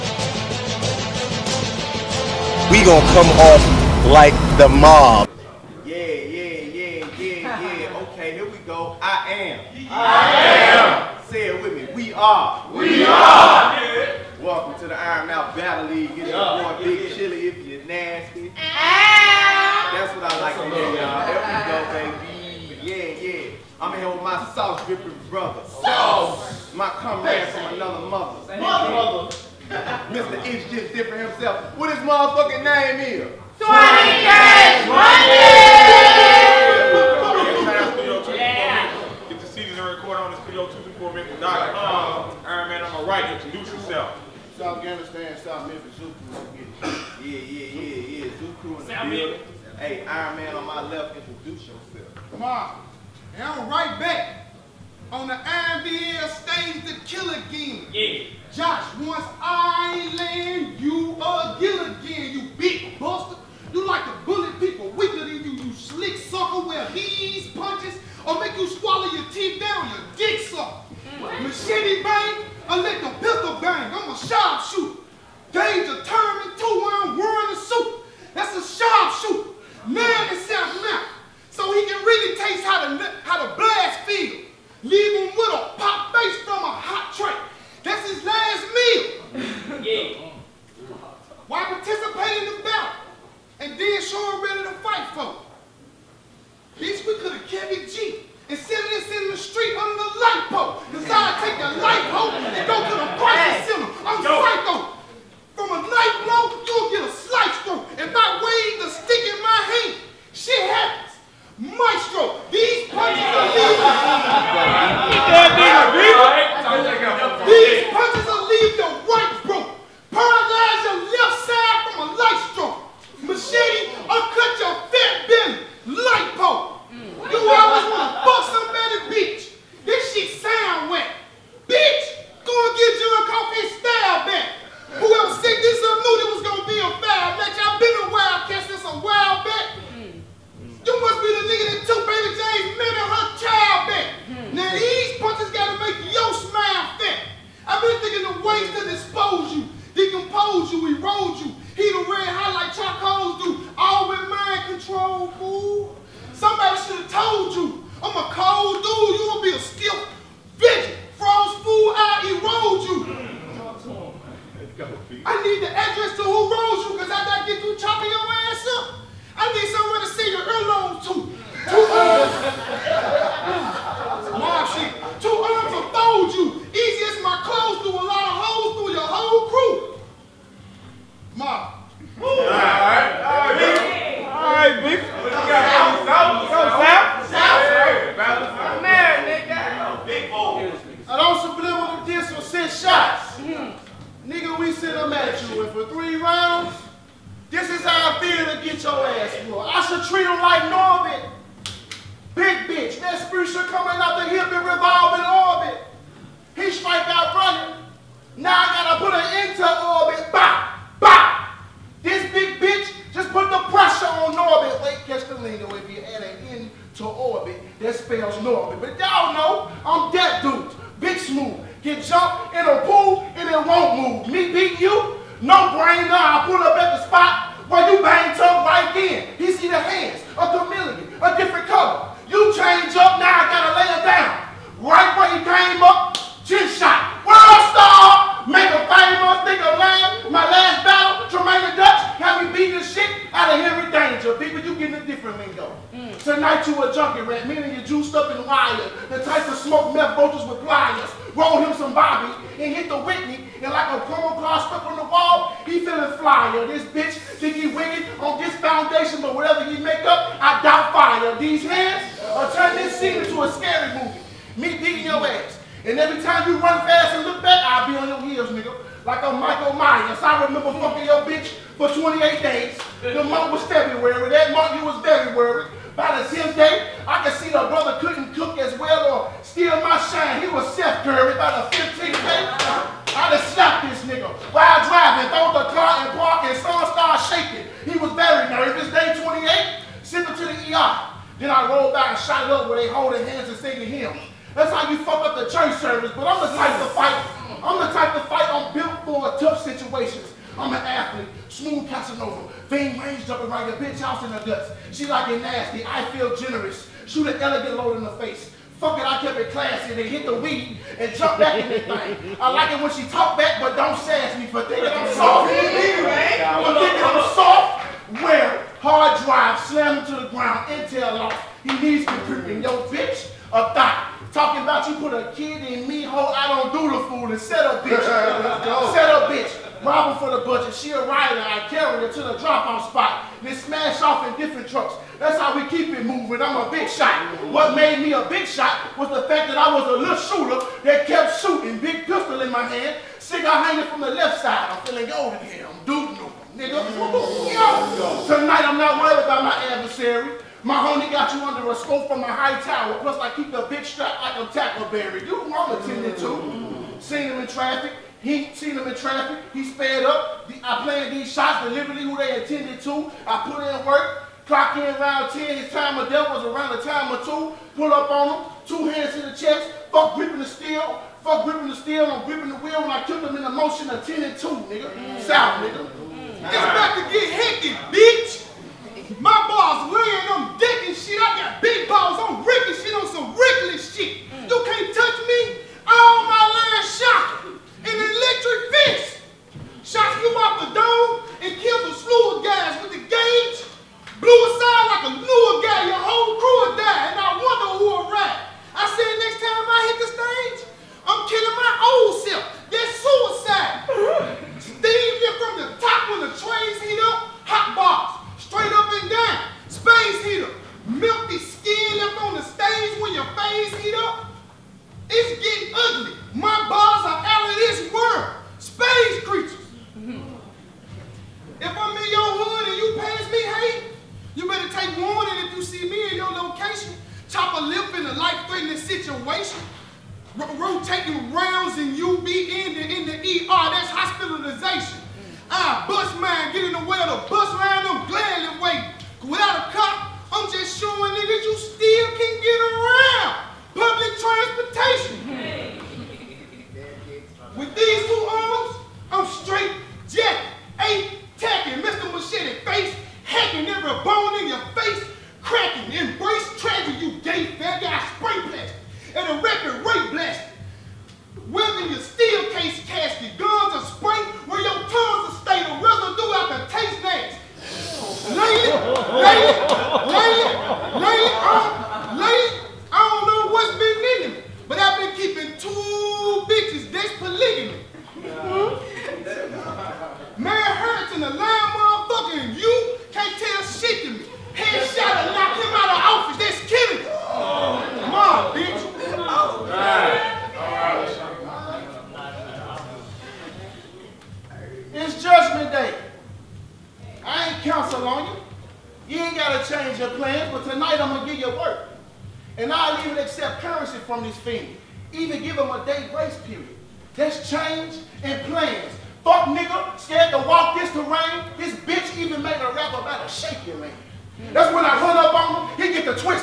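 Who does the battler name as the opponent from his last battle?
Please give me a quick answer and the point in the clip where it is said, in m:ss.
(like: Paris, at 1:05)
Tremaine Dutch, at 4:01.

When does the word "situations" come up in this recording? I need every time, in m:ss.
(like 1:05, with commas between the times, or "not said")
4:59, 7:08.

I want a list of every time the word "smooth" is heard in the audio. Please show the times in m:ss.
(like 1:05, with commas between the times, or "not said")
3:41, 5:01.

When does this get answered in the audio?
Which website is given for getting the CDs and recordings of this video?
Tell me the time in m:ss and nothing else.
0:40.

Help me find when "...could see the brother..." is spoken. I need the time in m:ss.
4:37.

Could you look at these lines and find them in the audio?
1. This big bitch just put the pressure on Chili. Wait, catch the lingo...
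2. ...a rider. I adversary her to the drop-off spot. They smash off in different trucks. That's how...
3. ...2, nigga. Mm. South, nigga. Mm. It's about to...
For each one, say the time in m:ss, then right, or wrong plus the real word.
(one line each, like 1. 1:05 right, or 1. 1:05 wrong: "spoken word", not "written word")
1. 3:32 wrong: "Norbit", not "Chili"
2. 5:30 wrong: "carry", not "adversary"
3. 6:14 right.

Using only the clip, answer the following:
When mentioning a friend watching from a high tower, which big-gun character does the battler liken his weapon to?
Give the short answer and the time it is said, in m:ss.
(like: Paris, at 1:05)
Tackleberry, at 5:54.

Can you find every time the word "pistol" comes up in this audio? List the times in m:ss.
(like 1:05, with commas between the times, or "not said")
5:42.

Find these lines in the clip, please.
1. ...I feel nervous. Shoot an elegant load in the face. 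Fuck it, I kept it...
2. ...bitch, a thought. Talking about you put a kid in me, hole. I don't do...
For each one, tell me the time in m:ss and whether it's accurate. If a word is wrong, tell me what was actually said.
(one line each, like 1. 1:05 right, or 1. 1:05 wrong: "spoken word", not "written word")
1. 5:05 wrong: "generous", not "nervous"
2. 5:22 right.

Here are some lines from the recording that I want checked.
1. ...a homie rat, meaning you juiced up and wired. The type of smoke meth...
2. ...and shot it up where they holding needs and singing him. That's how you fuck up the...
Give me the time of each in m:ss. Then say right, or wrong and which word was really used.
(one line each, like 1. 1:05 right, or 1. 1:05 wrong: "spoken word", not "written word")
1. 4:06 wrong: "junkie", not "homie"
2. 4:52 wrong: "hands", not "needs".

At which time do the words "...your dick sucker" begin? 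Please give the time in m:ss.
1:09.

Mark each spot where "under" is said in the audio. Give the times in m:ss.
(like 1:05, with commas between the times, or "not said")
1:39, 5:51.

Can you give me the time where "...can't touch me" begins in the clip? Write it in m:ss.
6:24.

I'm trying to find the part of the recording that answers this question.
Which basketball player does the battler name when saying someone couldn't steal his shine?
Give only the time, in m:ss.
4:40.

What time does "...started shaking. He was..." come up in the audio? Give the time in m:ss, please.
4:46.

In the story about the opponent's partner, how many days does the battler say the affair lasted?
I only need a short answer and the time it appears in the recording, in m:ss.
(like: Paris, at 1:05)
28, at 4:31.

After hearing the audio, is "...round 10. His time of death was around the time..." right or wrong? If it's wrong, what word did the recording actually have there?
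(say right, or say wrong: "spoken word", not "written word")
right.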